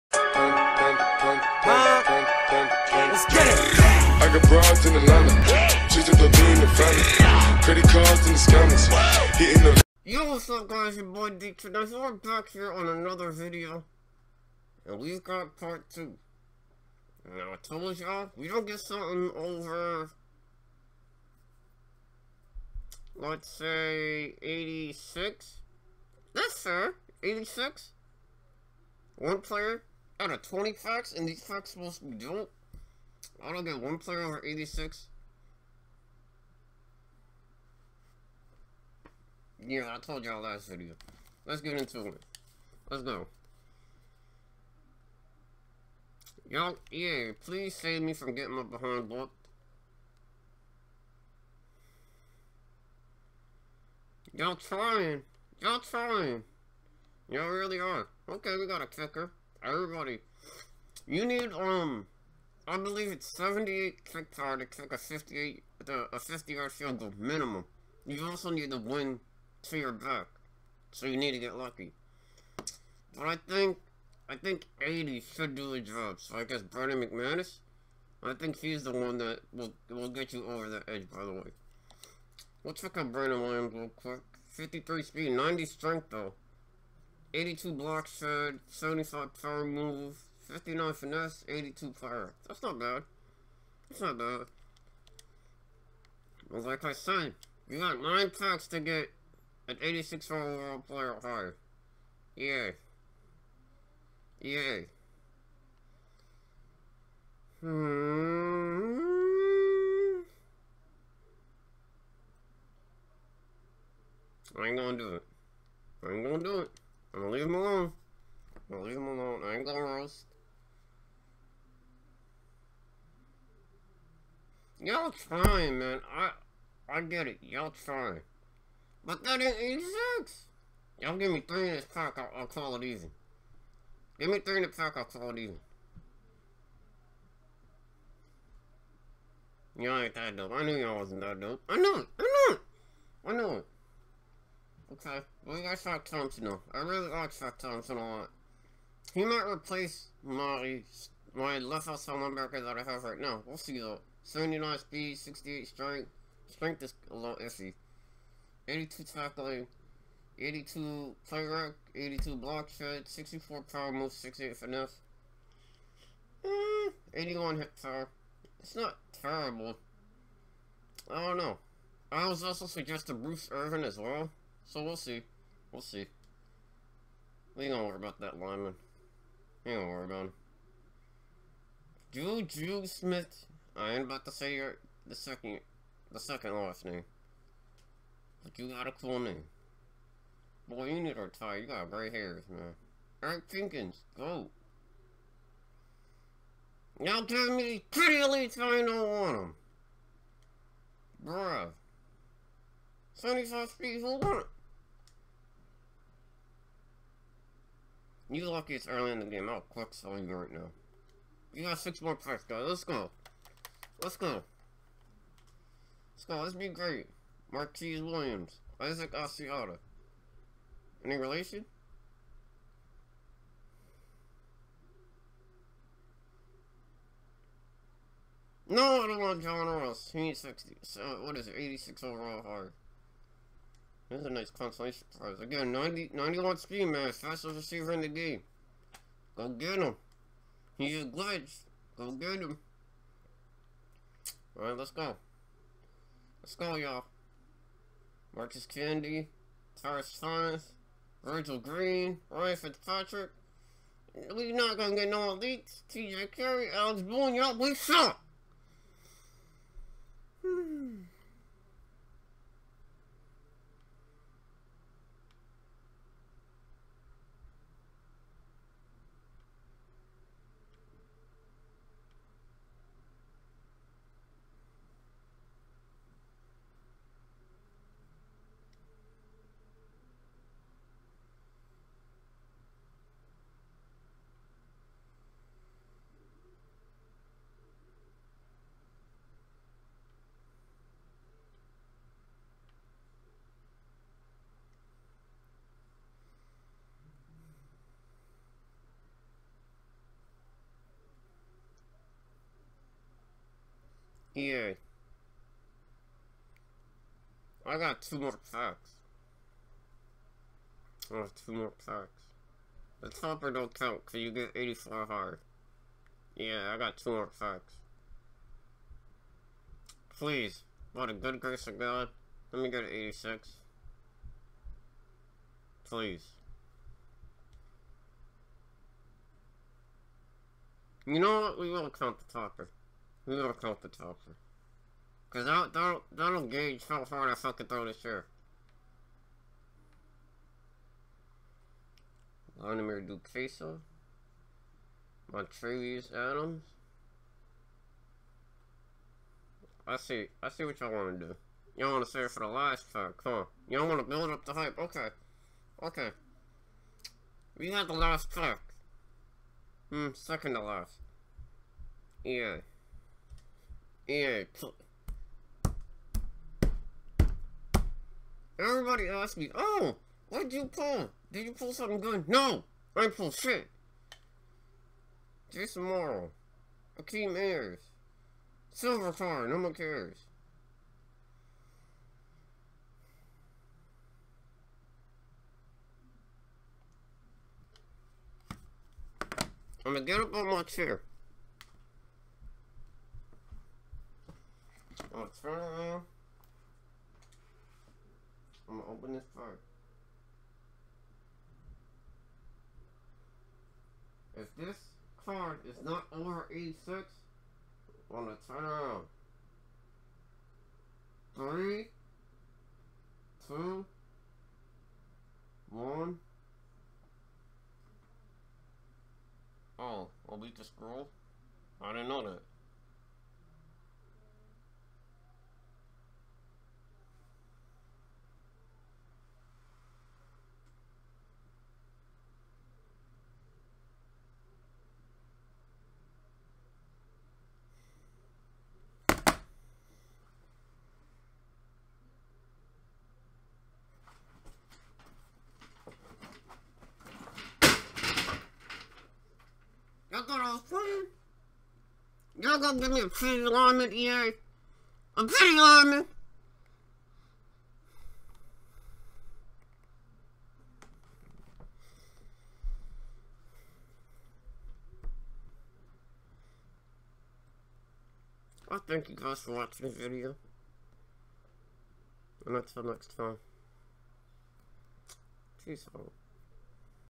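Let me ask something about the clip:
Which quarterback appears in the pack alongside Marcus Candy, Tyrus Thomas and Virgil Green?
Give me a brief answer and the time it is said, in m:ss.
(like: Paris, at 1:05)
Ryan Fitzpatrick, at 4:12.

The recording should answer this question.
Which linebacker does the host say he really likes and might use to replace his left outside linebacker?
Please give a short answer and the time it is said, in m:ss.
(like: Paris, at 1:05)
Shaq Thompson, at 2:27.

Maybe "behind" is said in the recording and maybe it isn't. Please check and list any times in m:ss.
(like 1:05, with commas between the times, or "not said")
0:48.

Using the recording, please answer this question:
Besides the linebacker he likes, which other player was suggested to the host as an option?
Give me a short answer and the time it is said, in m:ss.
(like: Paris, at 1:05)
Bruce Irvin, at 2:53.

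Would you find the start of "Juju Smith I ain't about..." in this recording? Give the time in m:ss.
3:02.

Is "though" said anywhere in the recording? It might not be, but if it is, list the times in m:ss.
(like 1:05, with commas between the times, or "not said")
1:26, 2:26, 2:33.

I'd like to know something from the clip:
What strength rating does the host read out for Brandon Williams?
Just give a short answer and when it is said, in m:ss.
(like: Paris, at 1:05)
90, at 1:25.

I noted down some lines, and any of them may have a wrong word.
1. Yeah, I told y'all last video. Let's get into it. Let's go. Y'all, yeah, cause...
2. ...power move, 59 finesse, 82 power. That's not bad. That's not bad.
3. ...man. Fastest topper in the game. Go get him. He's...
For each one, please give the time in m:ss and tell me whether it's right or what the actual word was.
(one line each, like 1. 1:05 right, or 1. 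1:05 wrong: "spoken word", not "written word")
1. 0:39 wrong: "please", not "cause"
2. 1:29 right
3. 3:56 wrong: "receiver", not "topper".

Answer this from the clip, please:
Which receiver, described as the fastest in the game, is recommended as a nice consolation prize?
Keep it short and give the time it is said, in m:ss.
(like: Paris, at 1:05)
John Ross, at 3:49.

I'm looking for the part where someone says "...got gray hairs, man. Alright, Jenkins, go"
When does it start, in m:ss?
3:11.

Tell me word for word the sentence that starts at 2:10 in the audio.
Y'all give me three in this pack, I'll, I'll call it easy.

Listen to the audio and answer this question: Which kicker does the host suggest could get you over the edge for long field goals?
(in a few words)
Brandon McManus.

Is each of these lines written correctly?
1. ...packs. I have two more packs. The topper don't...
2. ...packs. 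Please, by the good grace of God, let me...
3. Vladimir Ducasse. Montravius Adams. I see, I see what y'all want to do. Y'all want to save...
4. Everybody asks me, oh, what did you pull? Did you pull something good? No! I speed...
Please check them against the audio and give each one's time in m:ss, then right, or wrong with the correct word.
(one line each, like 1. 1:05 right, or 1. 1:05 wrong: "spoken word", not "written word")
1. 5:08 right
2. 5:17 right
3. 5:42 right
4. 6:08 wrong: "pulled", not "speed".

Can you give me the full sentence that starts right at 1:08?
You also need to win to your back, so you need to get lucky.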